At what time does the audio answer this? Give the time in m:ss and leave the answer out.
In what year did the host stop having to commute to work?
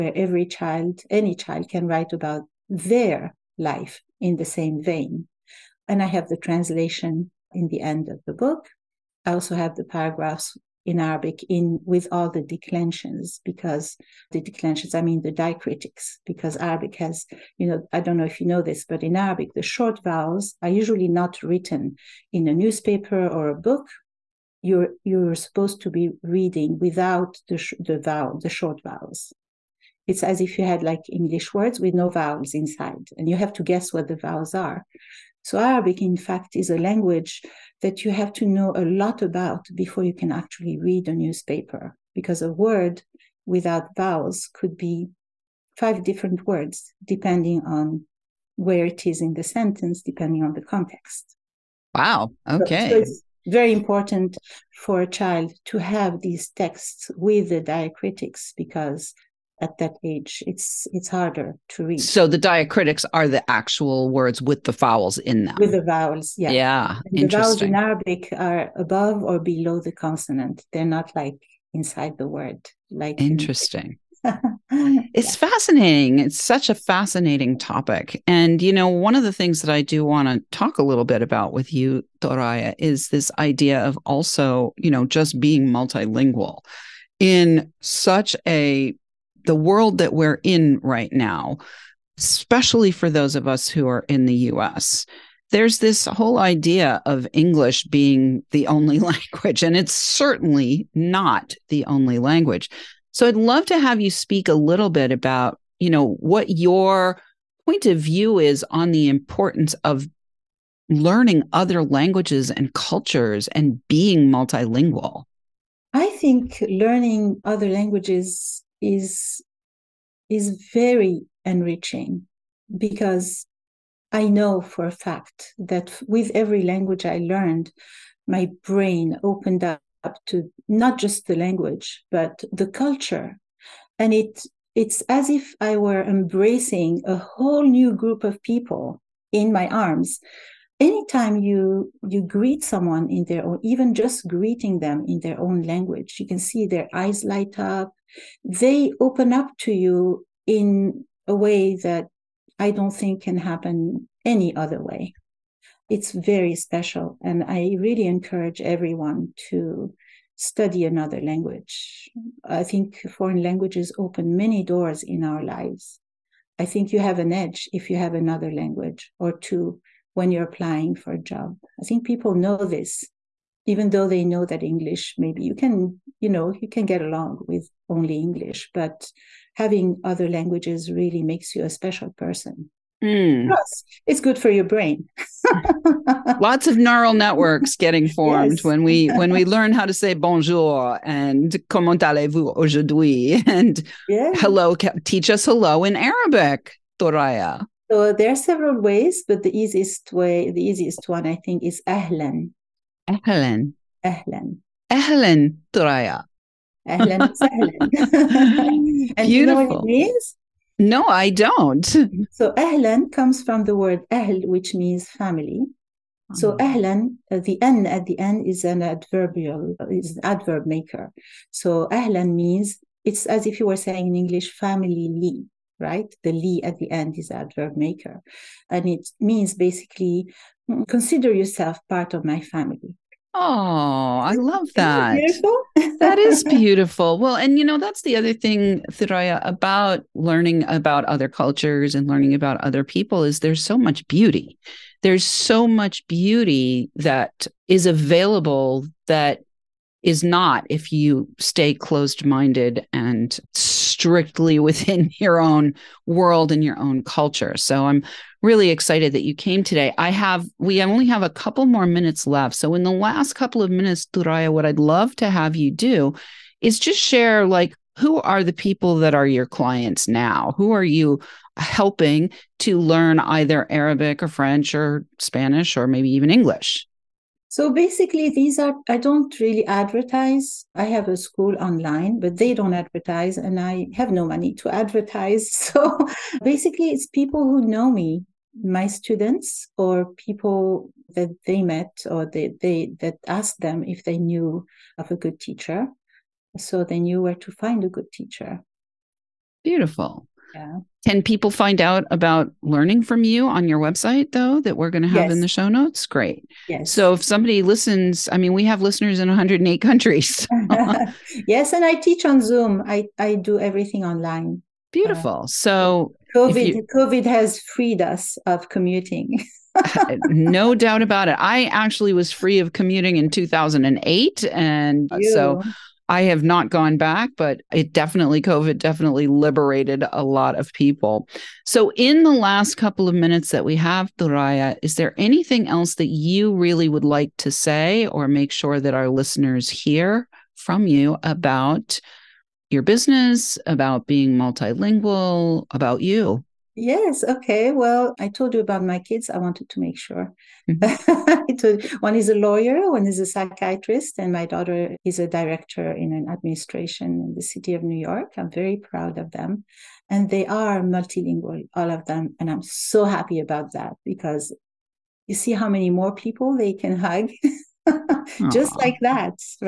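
5:23.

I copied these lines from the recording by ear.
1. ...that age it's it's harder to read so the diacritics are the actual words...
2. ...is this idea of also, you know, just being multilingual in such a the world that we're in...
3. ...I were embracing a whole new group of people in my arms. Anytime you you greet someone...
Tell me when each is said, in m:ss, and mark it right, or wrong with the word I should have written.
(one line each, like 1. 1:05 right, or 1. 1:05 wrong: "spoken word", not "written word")
1. 0:59 right
2. 1:22 right
3. 2:15 right.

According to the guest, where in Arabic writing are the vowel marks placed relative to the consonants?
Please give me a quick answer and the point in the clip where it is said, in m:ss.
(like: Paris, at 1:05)
Above or below, at 1:08.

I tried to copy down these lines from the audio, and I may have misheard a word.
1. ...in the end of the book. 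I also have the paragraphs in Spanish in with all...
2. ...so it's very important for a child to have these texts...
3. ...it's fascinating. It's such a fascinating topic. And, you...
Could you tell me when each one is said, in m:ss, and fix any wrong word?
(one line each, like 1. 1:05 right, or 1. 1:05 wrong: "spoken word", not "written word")
1. 0:07 wrong: "Arabic", not "Spanish"
2. 0:52 right
3. 1:15 right.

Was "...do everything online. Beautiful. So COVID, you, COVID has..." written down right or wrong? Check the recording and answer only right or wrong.
right.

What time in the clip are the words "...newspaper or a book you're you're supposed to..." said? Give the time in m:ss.
0:22.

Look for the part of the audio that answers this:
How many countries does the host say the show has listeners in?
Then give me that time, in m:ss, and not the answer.
5:09.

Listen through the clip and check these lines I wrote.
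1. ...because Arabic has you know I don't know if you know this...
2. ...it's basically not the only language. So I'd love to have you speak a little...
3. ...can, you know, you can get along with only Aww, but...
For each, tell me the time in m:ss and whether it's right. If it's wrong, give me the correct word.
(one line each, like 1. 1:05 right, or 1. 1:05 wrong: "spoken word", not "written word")
1. 0:16 right
2. 1:39 wrong: "certainly", not "basically"
3. 2:55 wrong: "English", not "Aww".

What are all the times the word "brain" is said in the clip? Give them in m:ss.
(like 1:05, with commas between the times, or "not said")
2:08, 3:04.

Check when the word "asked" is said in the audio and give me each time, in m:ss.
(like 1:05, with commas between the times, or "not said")
4:53.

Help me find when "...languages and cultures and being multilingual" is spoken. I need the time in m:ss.
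1:51.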